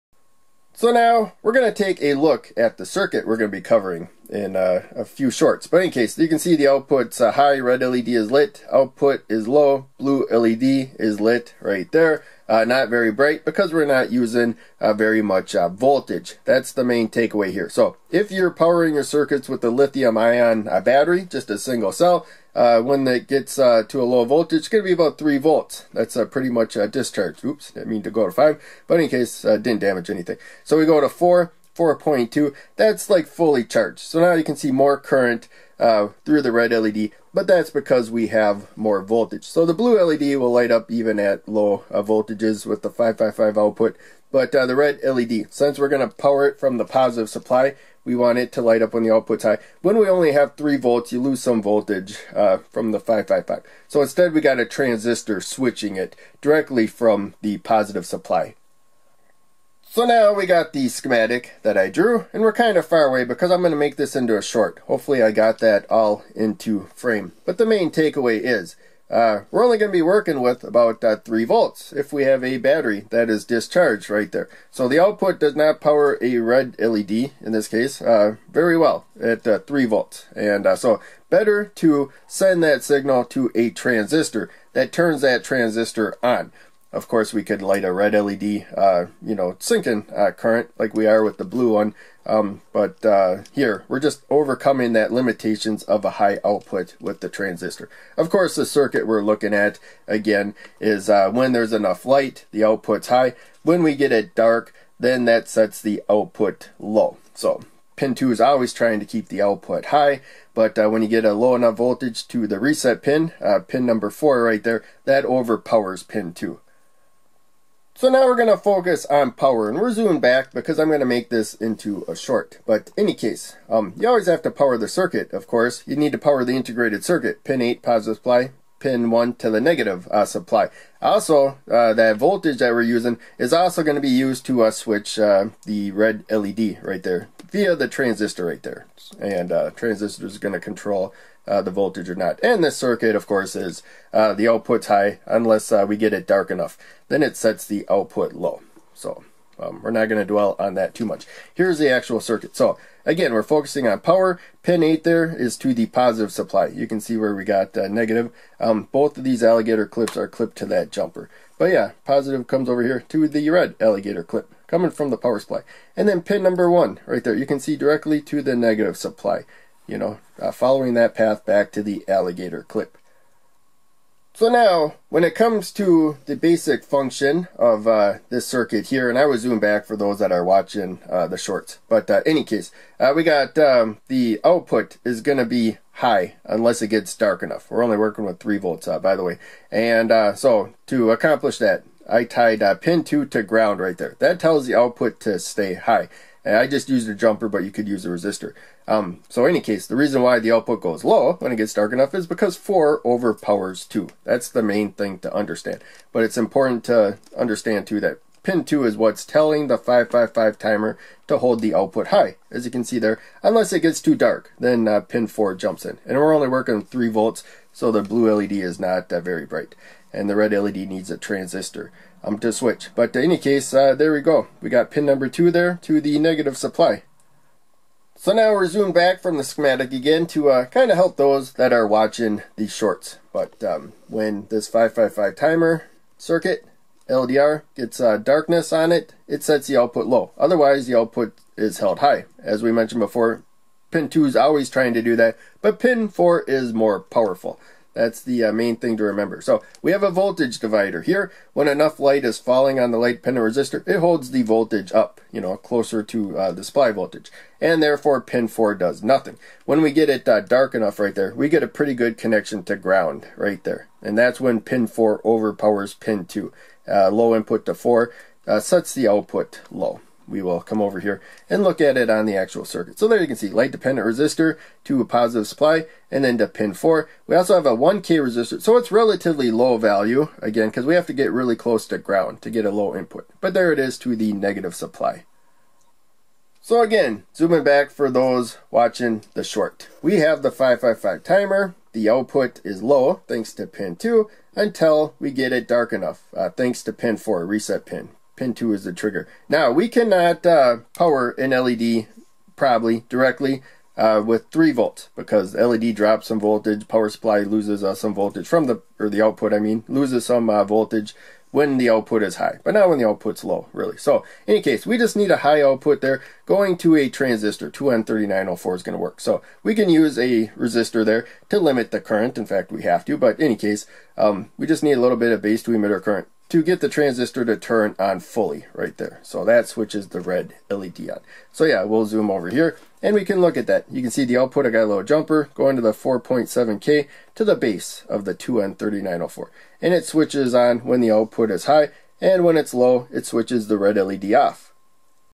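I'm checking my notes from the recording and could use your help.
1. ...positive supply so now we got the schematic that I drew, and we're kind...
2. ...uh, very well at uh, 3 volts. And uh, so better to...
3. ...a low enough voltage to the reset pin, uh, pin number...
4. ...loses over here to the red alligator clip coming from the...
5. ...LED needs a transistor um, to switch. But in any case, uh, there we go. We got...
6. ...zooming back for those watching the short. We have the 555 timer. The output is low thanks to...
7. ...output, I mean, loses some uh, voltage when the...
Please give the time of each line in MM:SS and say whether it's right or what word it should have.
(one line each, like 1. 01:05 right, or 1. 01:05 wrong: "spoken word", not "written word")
1. 00:57 right
2. 01:18 right
3. 01:51 right
4. 02:42 wrong: "comes", not "loses"
5. 03:40 right
6. 04:47 right
7. 05:09 right.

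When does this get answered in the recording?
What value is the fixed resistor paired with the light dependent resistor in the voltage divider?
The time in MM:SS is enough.
04:37.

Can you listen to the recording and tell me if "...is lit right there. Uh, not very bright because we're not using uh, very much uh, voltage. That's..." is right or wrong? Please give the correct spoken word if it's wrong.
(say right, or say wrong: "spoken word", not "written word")
right.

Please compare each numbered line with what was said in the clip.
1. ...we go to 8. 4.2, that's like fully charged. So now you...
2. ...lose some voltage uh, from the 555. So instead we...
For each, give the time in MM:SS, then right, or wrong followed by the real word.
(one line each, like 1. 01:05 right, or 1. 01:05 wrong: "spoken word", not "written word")
1. 00:30 wrong: "4", not "8"
2. 00:51 right.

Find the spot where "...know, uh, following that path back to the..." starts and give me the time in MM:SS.
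02:49.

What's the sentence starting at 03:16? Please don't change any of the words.
And I just used a jumper, but you could use a resistor.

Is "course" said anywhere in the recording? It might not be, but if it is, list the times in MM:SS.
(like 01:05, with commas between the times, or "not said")
01:27, 01:38, 02:05, 02:23.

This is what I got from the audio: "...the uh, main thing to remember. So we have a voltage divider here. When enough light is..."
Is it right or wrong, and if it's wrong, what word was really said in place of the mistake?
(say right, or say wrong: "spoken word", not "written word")
right.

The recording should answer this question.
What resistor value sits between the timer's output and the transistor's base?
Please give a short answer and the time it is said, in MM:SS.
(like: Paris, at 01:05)
4.7K, at 05:35.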